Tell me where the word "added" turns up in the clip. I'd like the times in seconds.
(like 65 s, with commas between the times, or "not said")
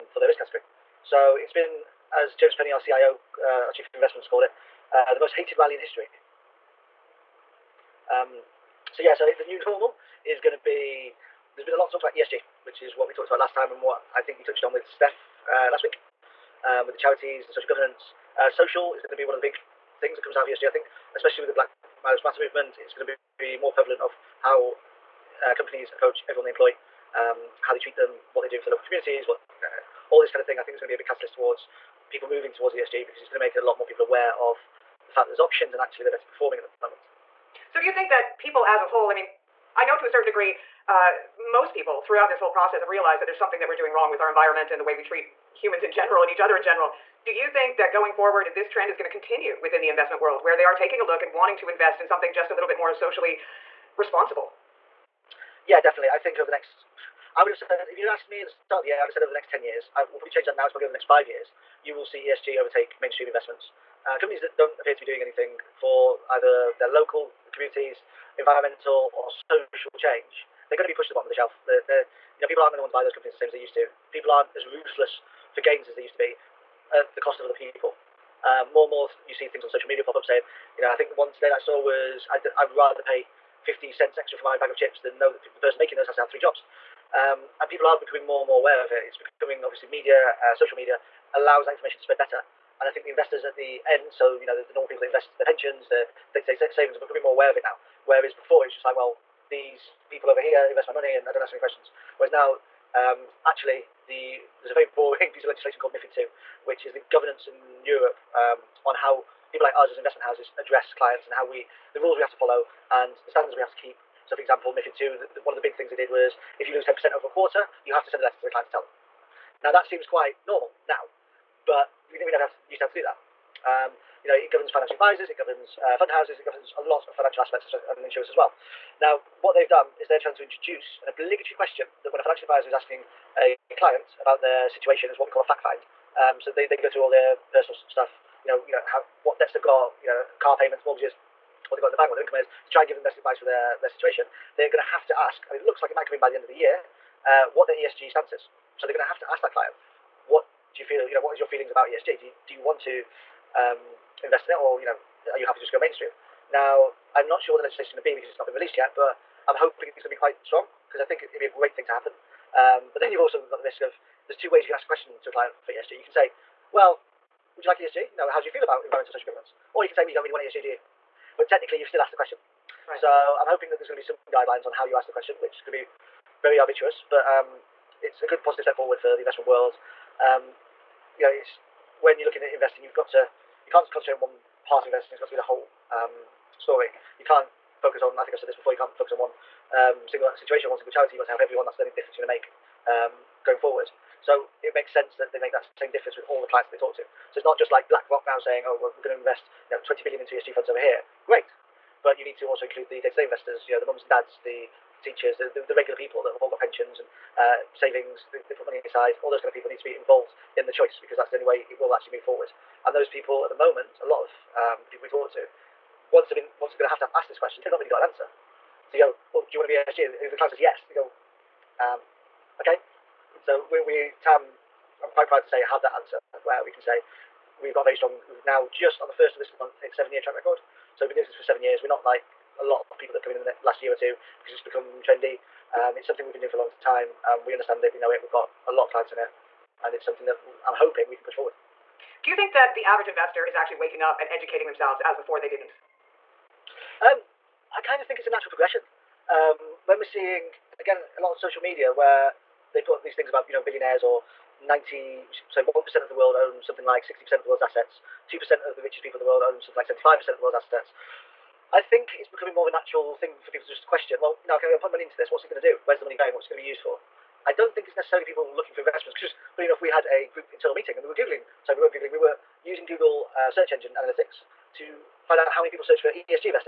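not said.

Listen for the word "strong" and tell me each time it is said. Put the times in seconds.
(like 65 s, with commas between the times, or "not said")
160 s, 227 s.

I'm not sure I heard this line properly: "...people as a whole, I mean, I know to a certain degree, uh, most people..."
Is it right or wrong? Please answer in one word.
right.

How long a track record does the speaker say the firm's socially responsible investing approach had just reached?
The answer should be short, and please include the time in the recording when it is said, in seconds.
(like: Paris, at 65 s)
7 years, at 229 s.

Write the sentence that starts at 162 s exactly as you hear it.
Um, but then you've also got the risk of there's two ways you can ask a question to a client for ESG.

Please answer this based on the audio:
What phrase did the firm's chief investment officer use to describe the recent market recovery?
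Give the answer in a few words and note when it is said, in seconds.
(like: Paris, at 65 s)
the most hated rally in history, at 5 s.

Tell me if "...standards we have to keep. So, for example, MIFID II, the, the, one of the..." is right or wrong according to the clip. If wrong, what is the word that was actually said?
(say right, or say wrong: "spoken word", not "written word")
right.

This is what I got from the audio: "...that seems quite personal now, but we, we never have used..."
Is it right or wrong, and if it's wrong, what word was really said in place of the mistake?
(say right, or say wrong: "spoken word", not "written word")
wrong: "normal", not "personal".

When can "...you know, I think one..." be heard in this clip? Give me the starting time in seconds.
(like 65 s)
80 s.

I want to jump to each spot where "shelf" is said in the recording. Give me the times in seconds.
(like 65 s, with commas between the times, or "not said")
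71 s.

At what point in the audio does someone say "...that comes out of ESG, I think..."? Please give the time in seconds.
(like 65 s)
20 s.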